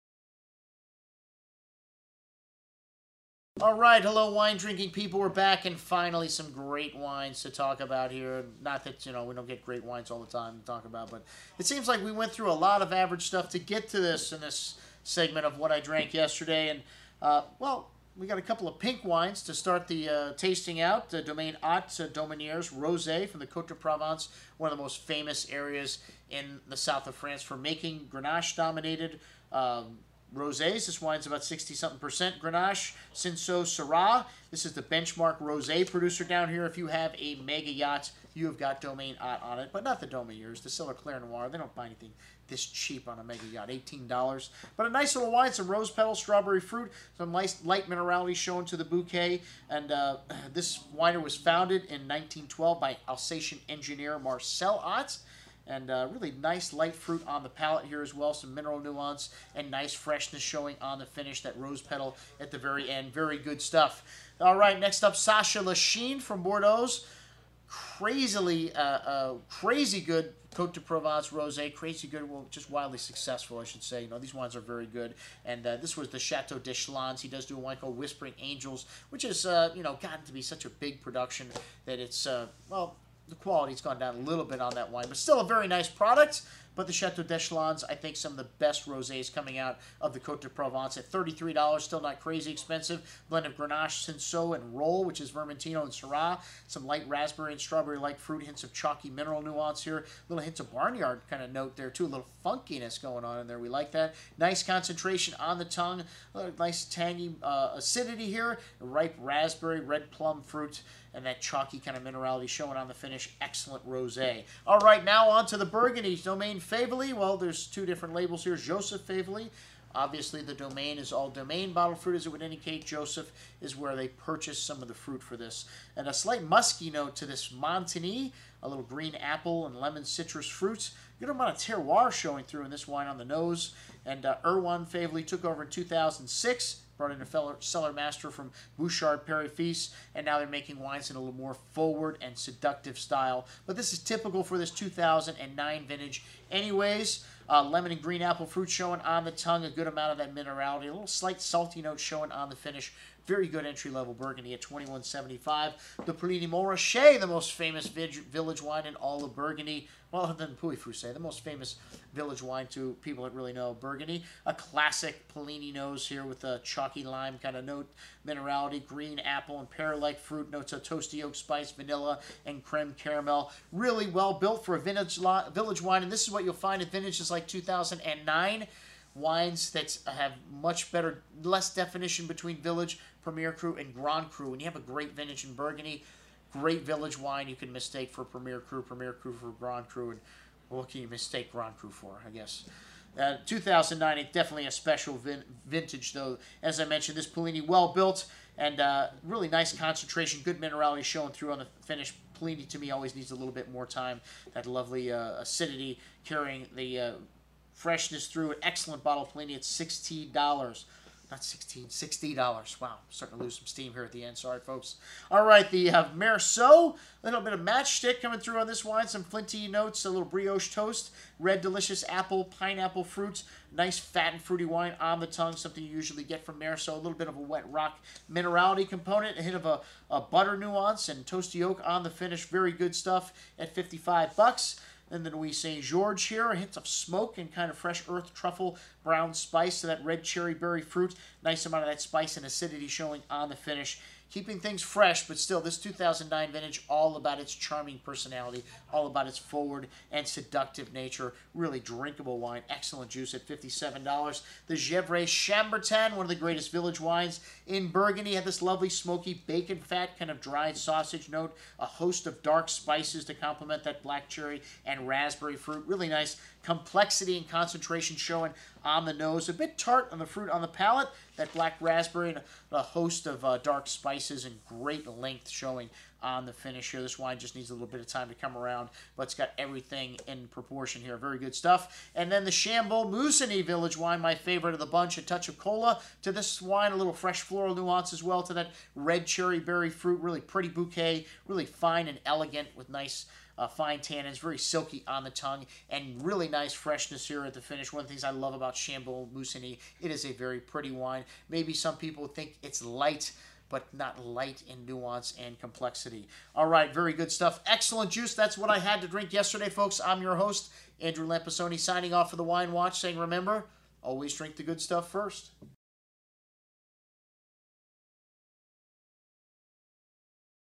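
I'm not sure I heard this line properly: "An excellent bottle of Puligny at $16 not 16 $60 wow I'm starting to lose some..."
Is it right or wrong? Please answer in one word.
right.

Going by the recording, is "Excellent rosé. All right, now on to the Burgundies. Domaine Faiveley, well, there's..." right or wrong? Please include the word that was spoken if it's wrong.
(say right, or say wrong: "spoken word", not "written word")
right.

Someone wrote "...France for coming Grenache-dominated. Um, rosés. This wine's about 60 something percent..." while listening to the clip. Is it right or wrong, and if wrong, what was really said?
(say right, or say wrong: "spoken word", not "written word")
wrong: "making", not "coming".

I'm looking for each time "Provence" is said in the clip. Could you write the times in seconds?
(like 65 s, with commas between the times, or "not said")
23 s, 70 s, 90 s.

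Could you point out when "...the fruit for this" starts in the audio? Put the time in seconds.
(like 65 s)
124 s.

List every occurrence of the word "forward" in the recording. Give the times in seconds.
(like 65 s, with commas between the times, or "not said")
141 s, 249 s.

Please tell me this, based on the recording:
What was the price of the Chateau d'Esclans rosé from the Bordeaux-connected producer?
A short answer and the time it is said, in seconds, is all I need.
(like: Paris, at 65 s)
$33, at 91 s.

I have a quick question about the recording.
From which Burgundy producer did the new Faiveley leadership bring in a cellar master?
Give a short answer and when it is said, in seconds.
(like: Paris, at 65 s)
Bouchard Père et Fils, at 138 s.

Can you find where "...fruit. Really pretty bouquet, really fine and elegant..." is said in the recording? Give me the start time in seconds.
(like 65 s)
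289 s.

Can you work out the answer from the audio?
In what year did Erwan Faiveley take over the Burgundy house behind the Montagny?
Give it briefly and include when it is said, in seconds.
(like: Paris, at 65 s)
2006, at 135 s.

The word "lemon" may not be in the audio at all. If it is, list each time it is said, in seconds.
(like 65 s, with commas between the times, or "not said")
129 s, 147 s.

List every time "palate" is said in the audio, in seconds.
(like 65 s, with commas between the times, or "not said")
57 s, 270 s.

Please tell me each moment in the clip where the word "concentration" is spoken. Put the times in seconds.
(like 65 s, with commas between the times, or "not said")
104 s, 199 s, 267 s.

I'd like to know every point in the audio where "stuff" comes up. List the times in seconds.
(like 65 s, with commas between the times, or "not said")
13 s, 63 s, 232 s, 281 s, 307 s, 314 s.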